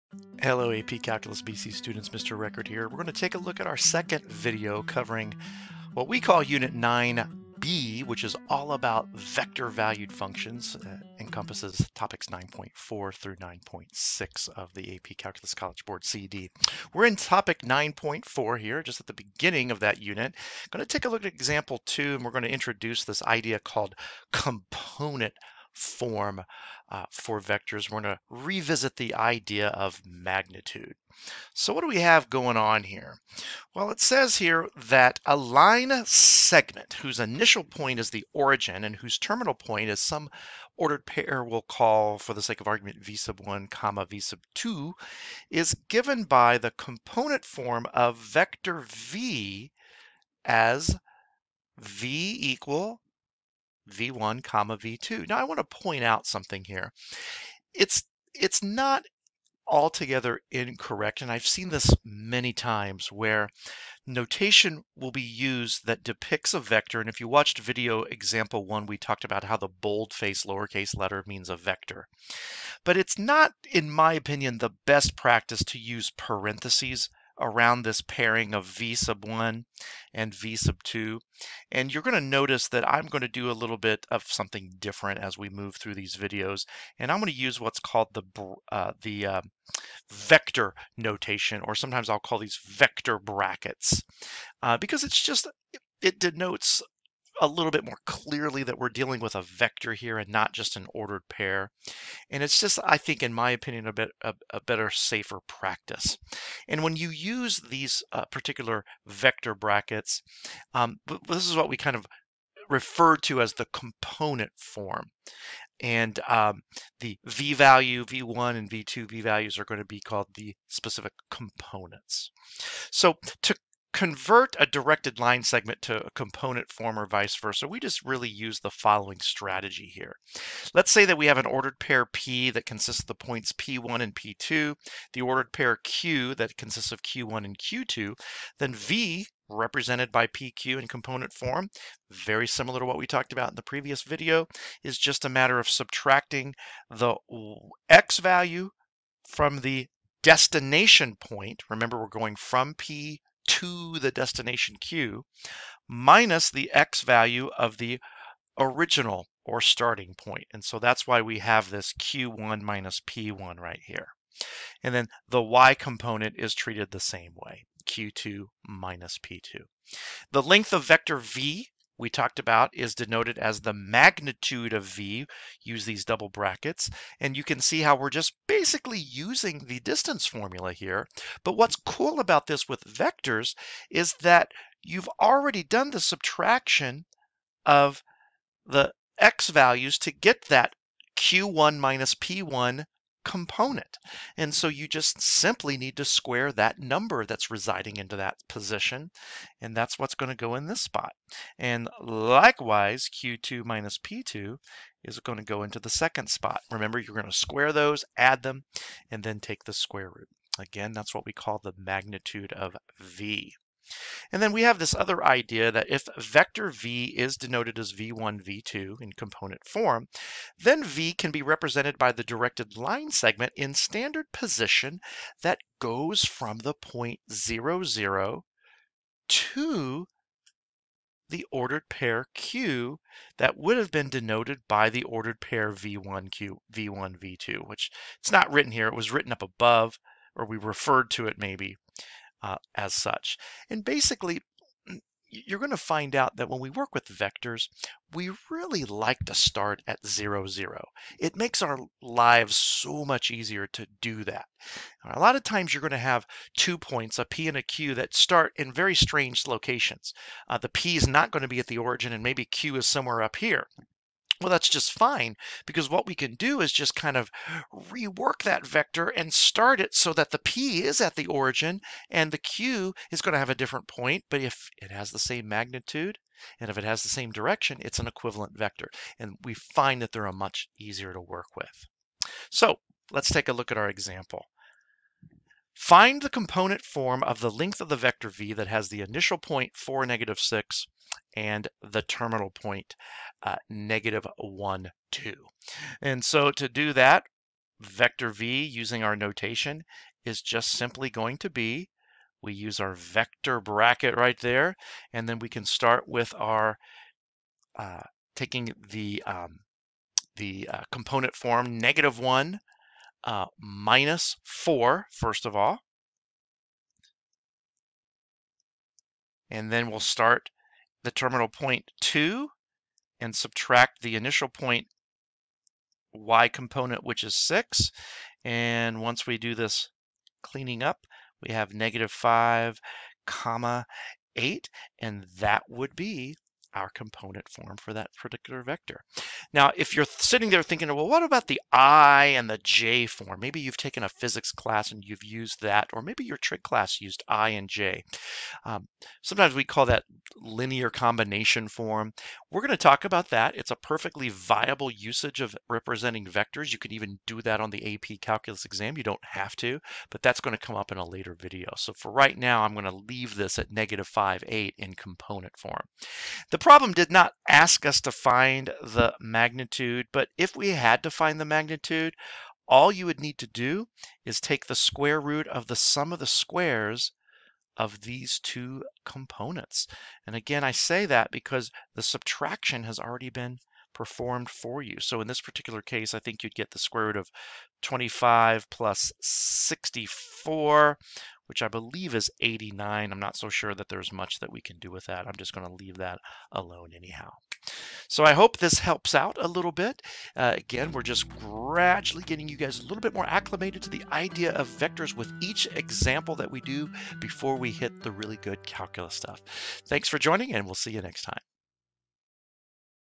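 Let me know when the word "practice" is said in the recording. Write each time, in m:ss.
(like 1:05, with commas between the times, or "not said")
1:15, 1:45.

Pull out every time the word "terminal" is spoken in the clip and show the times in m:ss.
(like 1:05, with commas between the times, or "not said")
0:39, 4:52, 5:21.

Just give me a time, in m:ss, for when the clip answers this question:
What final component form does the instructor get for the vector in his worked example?
5:31.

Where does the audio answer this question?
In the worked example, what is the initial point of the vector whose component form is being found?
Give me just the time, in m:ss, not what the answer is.
4:49.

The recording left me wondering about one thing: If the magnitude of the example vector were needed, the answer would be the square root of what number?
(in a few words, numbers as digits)
89.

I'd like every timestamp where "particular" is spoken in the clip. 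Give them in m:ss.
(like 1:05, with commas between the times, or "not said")
1:48, 5:38, 6:25.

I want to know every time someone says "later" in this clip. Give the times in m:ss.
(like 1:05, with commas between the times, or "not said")
6:01.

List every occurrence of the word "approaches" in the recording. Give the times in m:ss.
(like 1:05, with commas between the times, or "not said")
not said.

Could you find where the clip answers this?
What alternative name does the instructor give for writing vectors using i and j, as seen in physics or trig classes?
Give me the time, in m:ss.
5:50.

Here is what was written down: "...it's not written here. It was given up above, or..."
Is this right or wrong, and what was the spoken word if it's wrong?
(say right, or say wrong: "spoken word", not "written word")
wrong: "written", not "given".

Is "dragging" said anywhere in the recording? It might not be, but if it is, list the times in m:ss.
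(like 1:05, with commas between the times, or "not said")
not said.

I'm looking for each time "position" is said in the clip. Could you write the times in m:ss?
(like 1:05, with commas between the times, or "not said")
3:18, 3:44.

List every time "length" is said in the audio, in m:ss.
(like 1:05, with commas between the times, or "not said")
2:50, 4:47.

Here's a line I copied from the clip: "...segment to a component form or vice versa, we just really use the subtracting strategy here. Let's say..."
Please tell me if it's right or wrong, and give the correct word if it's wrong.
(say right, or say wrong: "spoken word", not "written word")
wrong: "following", not "subtracting".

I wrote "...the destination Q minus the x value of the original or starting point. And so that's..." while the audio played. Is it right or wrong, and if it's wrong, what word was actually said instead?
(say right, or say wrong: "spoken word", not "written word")
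right.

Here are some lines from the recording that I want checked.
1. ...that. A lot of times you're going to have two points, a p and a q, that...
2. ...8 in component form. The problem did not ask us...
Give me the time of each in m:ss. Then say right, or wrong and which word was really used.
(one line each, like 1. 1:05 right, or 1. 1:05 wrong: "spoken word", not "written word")
1. 4:14 right
2. 6:04 right.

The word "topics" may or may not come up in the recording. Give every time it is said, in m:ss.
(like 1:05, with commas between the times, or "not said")
0:11, 0:17.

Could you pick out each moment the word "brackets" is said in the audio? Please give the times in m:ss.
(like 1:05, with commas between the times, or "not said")
1:33, 1:49, 2:56, 5:03.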